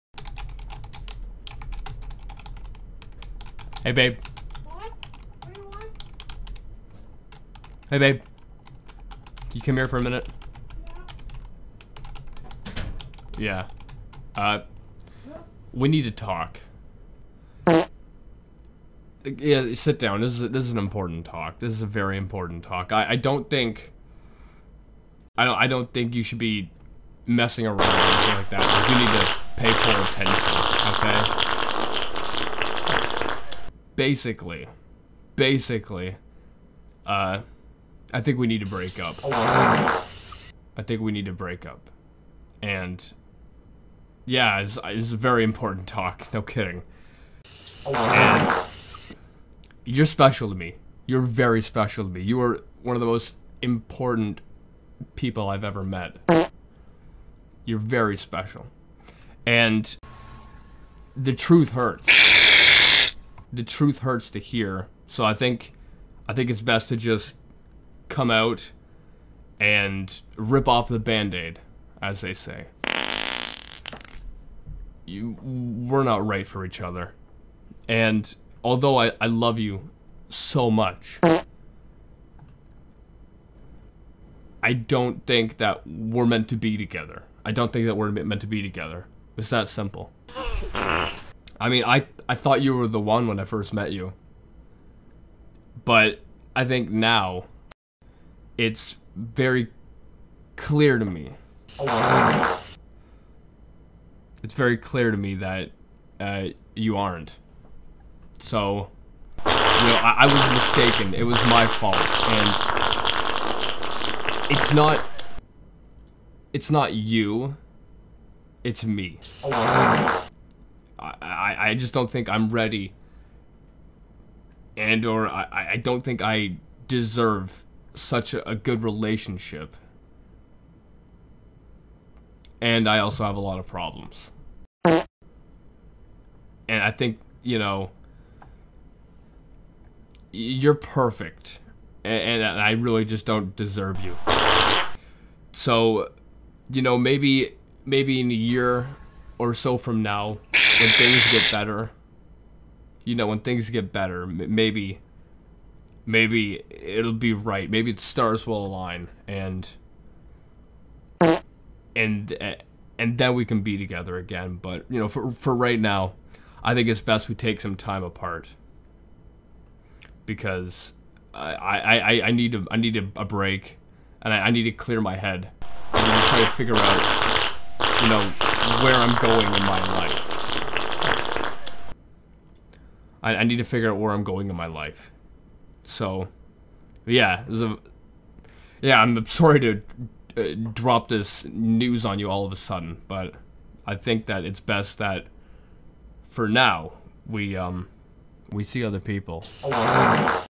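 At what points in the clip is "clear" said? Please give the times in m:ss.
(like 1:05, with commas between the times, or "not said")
1:40, 1:44, 2:54.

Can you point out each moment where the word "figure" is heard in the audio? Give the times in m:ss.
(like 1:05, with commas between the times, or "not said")
2:56, 3:03.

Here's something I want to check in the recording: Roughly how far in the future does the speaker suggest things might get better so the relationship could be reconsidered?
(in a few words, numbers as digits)
a year.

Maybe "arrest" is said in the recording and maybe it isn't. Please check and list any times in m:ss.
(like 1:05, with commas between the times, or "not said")
not said.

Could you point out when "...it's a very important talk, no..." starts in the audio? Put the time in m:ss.
0:44.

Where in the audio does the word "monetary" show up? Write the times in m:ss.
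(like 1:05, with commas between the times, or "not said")
not said.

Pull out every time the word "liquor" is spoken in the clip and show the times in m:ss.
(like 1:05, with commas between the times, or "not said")
not said.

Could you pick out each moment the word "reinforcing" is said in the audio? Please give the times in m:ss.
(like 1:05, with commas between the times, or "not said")
not said.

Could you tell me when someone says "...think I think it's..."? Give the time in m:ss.
1:05.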